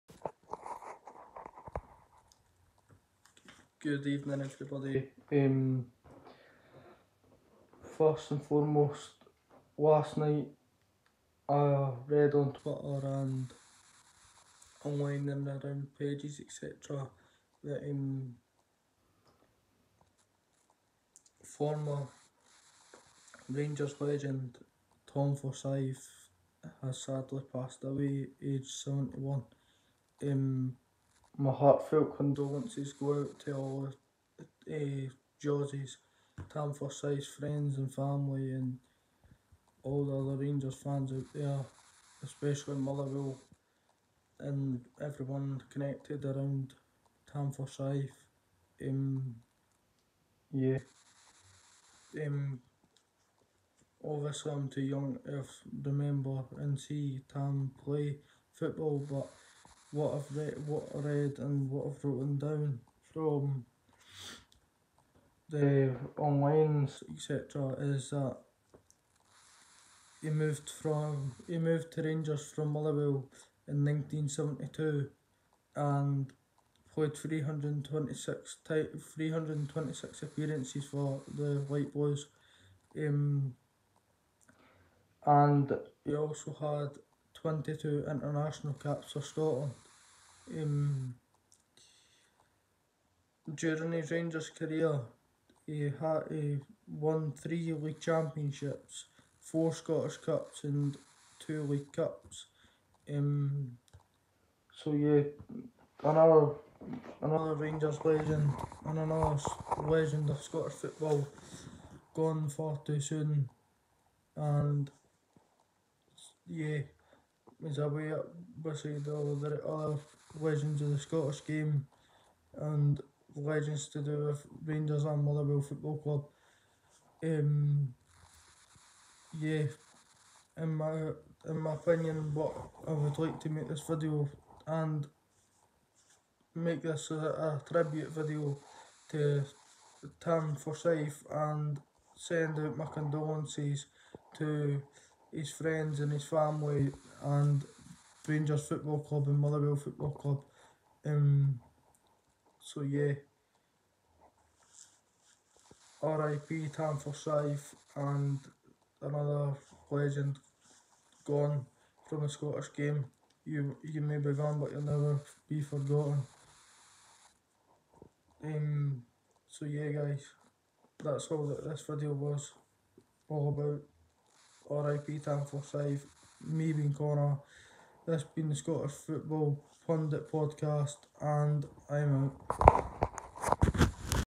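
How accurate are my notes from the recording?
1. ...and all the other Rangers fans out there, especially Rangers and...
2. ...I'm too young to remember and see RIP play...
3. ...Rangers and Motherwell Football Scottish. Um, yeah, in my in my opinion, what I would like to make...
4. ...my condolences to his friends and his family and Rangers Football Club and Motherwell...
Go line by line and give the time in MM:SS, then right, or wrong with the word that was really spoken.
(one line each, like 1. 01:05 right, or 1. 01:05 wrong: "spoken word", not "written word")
1. 00:38 wrong: "Motherwell", not "Rangers"
2. 00:54 wrong: "Tam", not "RIP"
3. 02:04 wrong: "Club", not "Scottish"
4. 02:22 right.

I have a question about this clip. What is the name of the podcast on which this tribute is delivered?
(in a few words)
Scottish Football Pundit Podcast.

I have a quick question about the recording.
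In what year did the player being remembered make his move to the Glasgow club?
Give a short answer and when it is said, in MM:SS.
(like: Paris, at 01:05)
1972, at 01:13.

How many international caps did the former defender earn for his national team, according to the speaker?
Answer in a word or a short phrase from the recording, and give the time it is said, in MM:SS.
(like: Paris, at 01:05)
22, at 01:27.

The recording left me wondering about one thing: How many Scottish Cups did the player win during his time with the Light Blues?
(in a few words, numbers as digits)
4.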